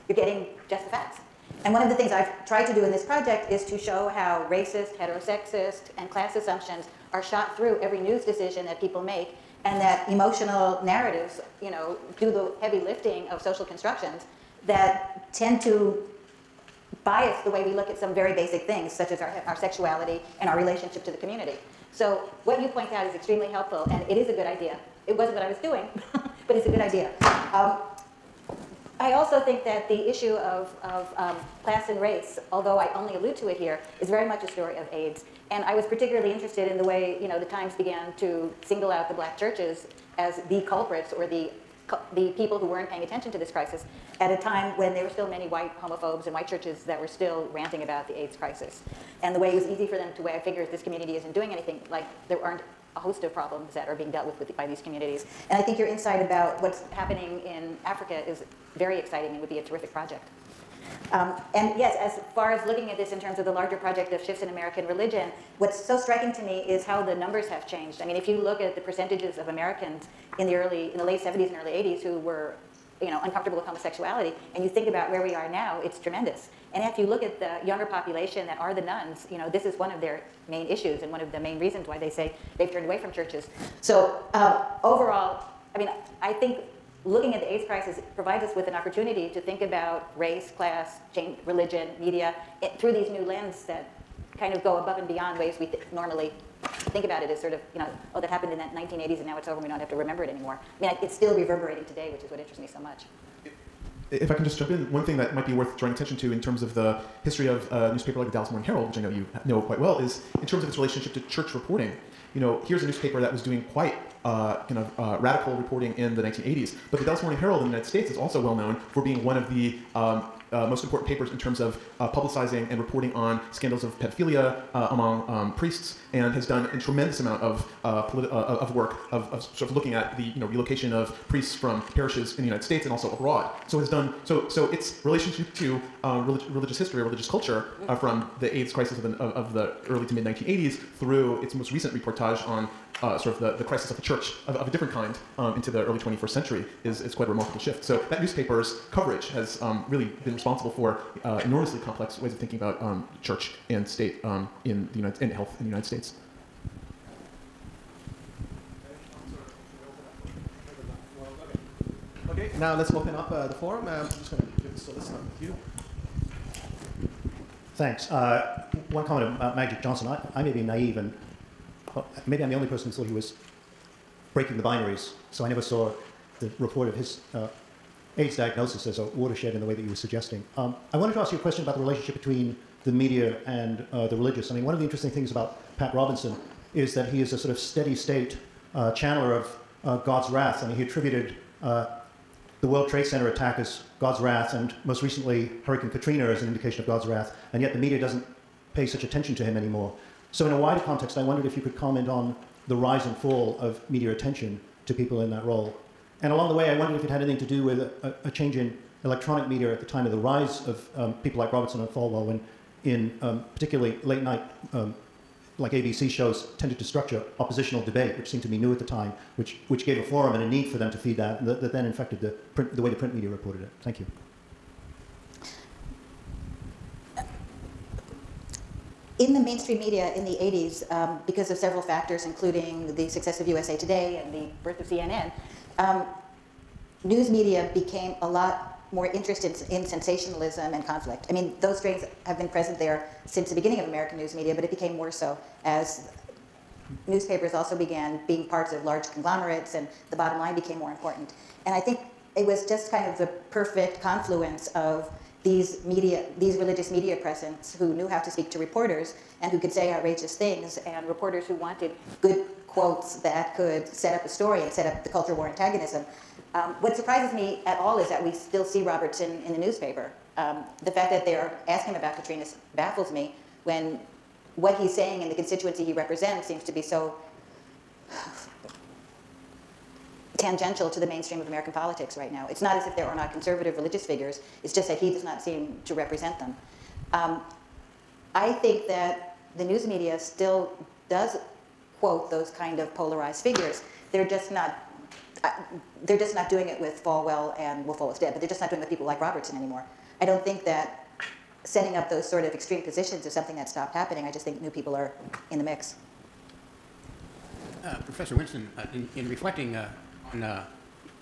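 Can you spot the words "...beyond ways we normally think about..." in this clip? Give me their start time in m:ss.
1:35.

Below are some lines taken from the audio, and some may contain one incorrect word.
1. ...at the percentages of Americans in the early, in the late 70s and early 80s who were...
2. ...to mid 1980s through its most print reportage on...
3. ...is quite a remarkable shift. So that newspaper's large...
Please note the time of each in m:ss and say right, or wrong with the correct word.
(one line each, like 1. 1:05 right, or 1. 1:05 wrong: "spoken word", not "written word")
1. 1:08 right
2. 2:20 wrong: "recent", not "print"
3. 2:27 wrong: "coverage", not "large".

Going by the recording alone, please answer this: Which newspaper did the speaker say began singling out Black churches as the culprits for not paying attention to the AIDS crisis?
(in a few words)
The Times.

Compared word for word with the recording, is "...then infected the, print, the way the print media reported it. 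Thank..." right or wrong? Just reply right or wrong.
right.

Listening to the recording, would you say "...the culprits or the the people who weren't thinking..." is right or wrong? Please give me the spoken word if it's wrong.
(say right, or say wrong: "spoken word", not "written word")
wrong: "paying", not "thinking".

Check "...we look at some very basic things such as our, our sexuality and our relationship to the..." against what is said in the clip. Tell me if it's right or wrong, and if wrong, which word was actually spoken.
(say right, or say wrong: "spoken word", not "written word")
right.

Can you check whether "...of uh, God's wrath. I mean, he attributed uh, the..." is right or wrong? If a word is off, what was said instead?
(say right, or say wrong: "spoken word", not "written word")
right.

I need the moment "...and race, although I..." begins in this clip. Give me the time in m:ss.
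0:31.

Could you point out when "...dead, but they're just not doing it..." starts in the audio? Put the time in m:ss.
4:58.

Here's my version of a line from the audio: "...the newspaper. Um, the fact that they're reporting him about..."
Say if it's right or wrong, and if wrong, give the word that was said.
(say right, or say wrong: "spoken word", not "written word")
wrong: "asking", not "reporting".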